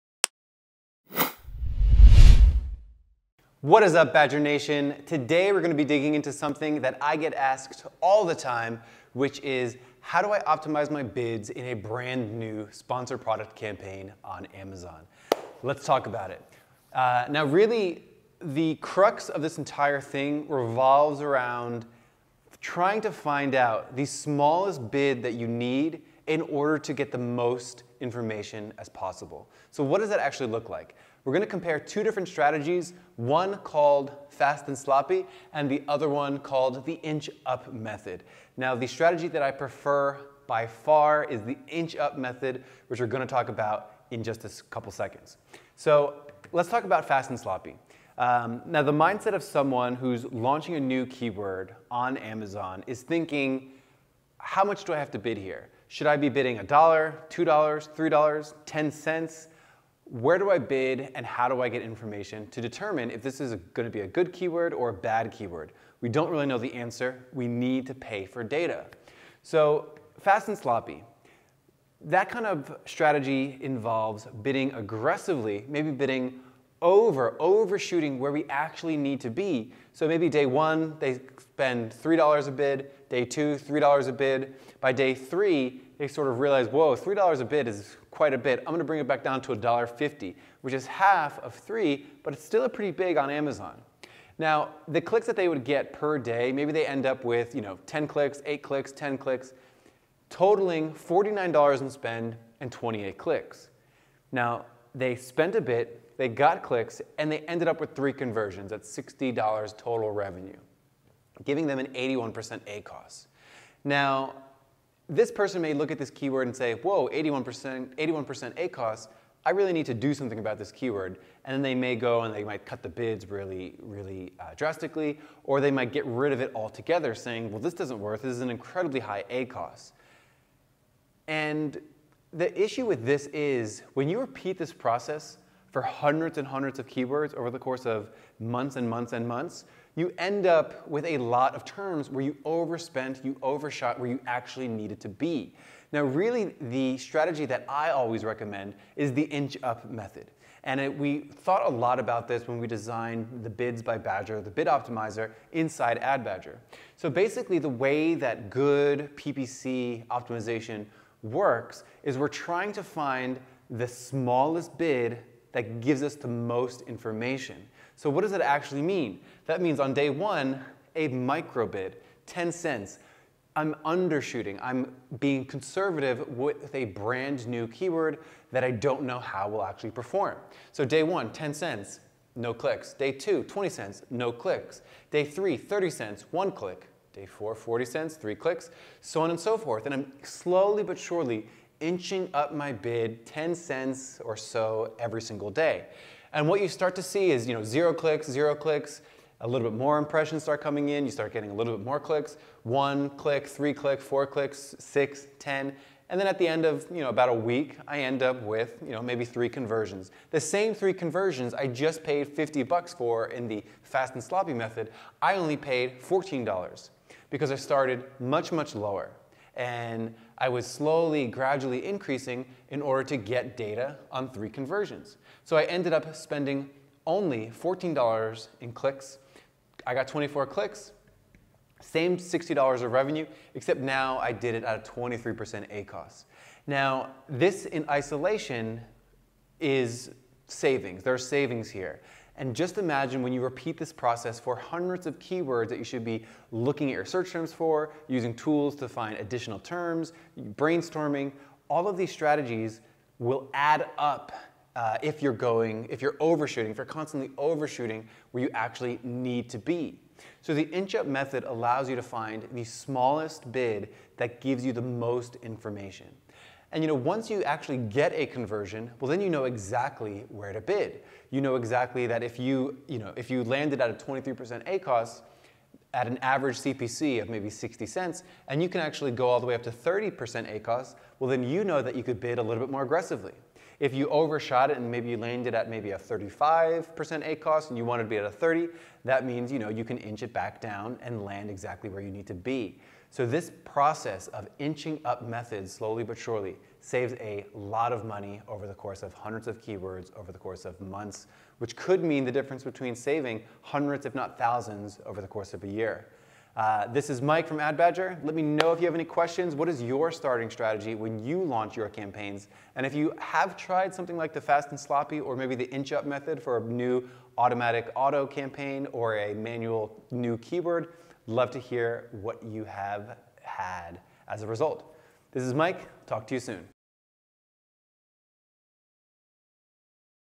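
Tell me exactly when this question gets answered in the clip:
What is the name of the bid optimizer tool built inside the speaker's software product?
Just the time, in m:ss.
2:33.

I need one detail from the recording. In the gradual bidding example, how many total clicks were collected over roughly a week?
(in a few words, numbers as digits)
24.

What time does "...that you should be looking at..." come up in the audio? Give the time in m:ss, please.
4:05.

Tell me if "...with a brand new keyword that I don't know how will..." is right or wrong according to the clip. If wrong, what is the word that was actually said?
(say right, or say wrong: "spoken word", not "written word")
right.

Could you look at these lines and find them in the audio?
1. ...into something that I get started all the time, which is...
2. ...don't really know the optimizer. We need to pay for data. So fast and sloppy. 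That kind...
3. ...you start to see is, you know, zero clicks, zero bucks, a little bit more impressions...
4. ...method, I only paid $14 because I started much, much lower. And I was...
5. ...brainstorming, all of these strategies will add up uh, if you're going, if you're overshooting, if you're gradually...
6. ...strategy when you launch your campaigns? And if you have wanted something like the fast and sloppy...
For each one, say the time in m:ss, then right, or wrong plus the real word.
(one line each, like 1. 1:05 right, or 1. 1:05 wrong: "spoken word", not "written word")
1. 0:06 wrong: "asked", not "started"
2. 1:06 wrong: "answer", not "optimizer"
3. 3:16 wrong: "clicks", not "bucks"
4. 3:34 right
5. 4:10 wrong: "constantly", not "gradually"
6. 5:10 wrong: "tried", not "wanted".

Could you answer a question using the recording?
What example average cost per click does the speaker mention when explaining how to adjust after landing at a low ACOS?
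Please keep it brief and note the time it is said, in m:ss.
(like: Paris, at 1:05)
60 cents, at 4:37.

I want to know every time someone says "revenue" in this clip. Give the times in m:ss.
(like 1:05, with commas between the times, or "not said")
1:50, 3:52.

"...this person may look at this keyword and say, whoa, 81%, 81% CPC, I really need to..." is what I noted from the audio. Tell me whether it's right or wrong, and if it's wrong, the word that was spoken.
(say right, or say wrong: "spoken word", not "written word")
wrong: "ACOS", not "CPC".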